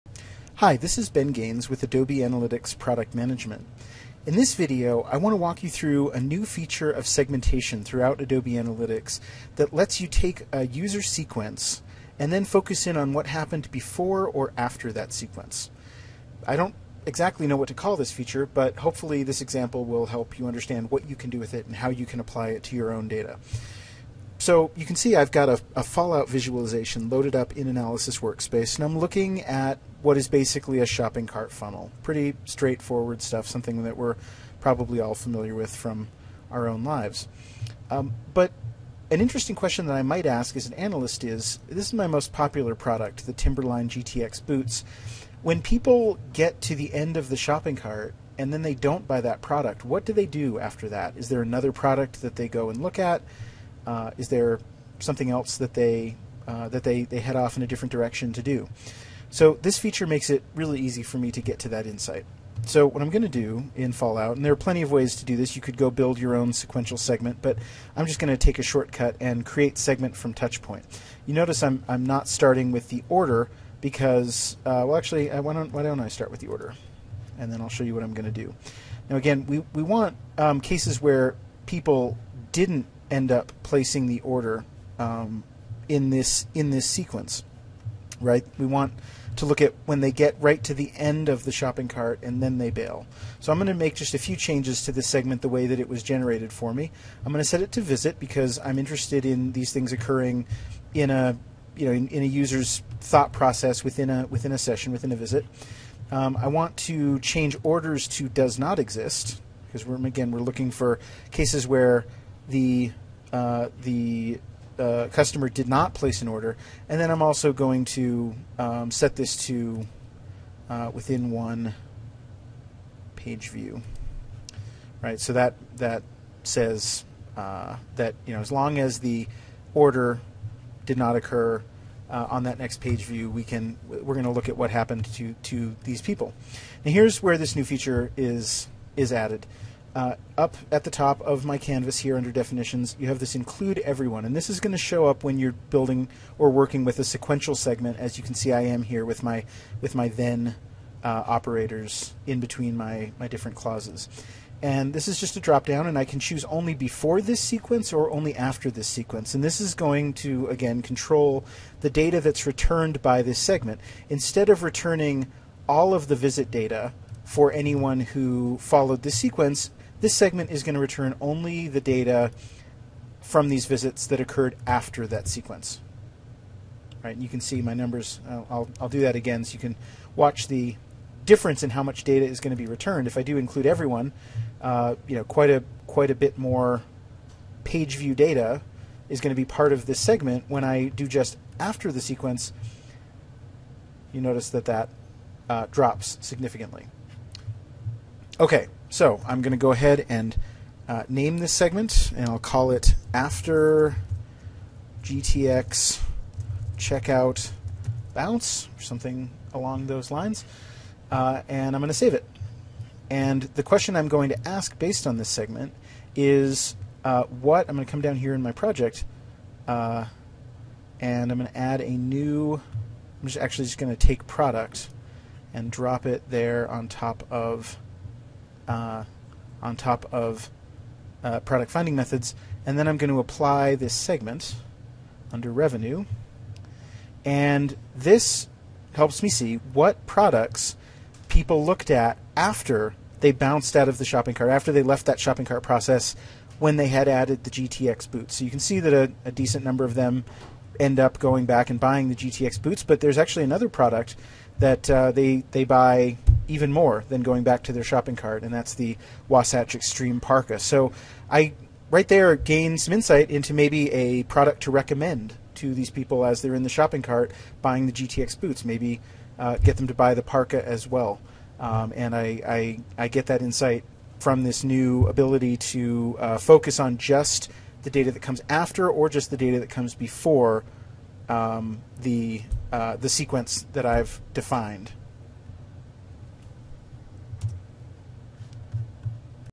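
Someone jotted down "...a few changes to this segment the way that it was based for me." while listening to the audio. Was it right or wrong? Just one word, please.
wrong.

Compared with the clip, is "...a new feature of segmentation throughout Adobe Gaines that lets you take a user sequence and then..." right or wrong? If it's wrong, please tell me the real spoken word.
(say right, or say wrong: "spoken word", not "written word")
wrong: "Analytics", not "Gaines".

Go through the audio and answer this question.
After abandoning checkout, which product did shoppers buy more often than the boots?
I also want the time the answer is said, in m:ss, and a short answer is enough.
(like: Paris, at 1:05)
Wasatch Extreme Parka, at 4:19.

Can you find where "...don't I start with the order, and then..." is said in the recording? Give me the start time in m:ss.
1:15.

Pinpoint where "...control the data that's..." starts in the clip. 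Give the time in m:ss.
2:40.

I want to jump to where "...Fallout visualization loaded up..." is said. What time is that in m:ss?
0:25.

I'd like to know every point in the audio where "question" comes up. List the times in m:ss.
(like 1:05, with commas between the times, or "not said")
0:39, 3:33.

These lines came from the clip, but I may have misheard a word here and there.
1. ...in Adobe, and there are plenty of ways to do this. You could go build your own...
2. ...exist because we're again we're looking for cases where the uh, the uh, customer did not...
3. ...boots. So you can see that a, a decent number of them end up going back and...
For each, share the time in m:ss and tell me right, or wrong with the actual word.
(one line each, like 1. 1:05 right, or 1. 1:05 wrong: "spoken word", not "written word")
1. 1:03 wrong: "Fallout", not "Adobe"
2. 1:48 right
3. 4:08 right.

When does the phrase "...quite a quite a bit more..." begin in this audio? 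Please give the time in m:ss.
3:05.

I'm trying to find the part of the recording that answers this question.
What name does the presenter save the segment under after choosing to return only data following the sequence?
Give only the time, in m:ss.
3:23.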